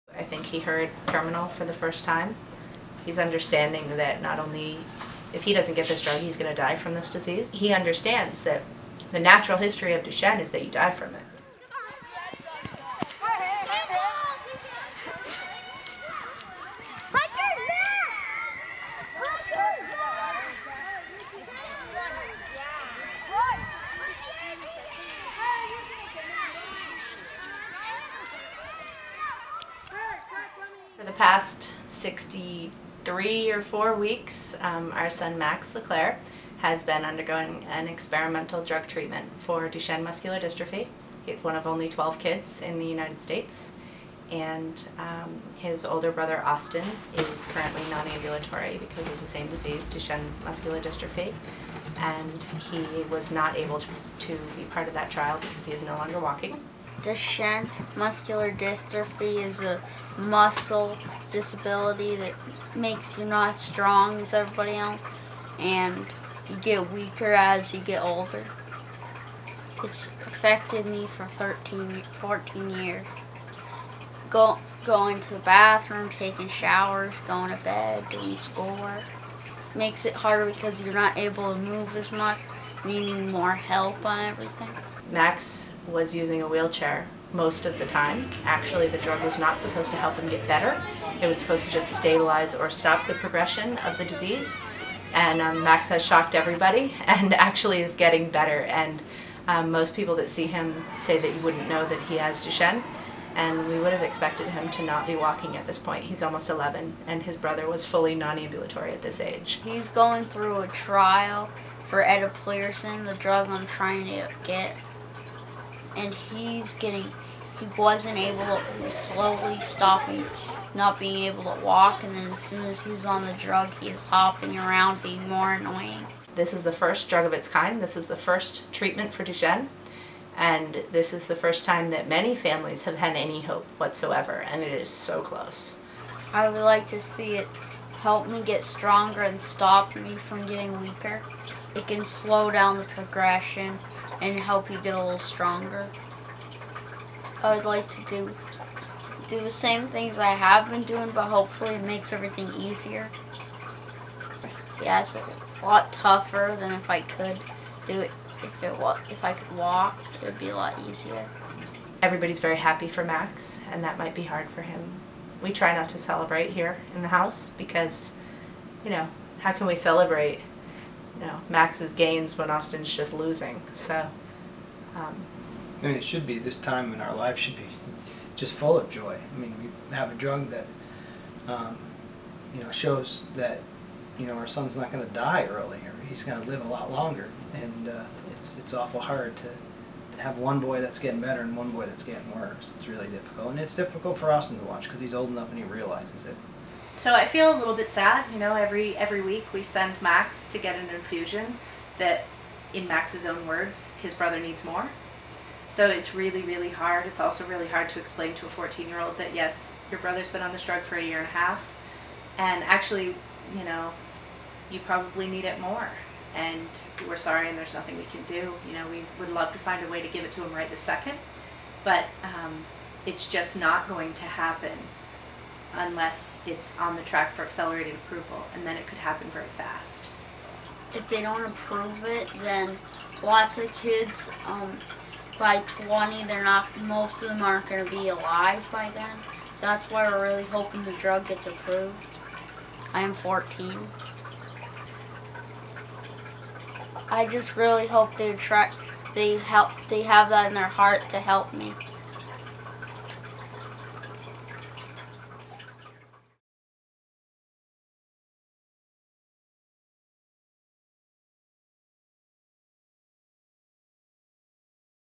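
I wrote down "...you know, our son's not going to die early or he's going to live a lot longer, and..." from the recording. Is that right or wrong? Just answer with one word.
right.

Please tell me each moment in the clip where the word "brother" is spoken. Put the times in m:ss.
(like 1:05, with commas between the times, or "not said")
0:46, 1:47, 3:24, 3:29.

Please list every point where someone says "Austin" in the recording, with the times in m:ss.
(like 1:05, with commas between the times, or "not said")
0:46, 2:52, 3:14.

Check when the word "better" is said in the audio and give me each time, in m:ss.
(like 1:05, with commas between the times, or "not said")
1:30, 1:38, 3:11.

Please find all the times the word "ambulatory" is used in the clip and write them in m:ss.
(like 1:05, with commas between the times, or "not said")
0:48, 1:48.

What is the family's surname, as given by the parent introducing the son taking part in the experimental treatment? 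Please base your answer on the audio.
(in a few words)
LeClaire.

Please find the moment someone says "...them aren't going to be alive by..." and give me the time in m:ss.
3:57.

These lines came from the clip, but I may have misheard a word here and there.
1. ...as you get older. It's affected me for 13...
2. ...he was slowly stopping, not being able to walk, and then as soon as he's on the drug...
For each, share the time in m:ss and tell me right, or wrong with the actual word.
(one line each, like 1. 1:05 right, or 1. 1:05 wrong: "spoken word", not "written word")
1. 1:07 right
2. 1:58 right.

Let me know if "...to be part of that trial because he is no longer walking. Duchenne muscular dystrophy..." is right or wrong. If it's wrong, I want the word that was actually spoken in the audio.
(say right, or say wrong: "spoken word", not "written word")
right.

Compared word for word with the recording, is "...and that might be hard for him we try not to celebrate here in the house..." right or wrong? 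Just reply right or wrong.
right.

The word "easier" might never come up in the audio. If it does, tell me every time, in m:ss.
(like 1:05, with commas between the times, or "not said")
2:32, 2:40.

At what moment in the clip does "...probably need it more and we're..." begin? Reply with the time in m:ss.
3:34.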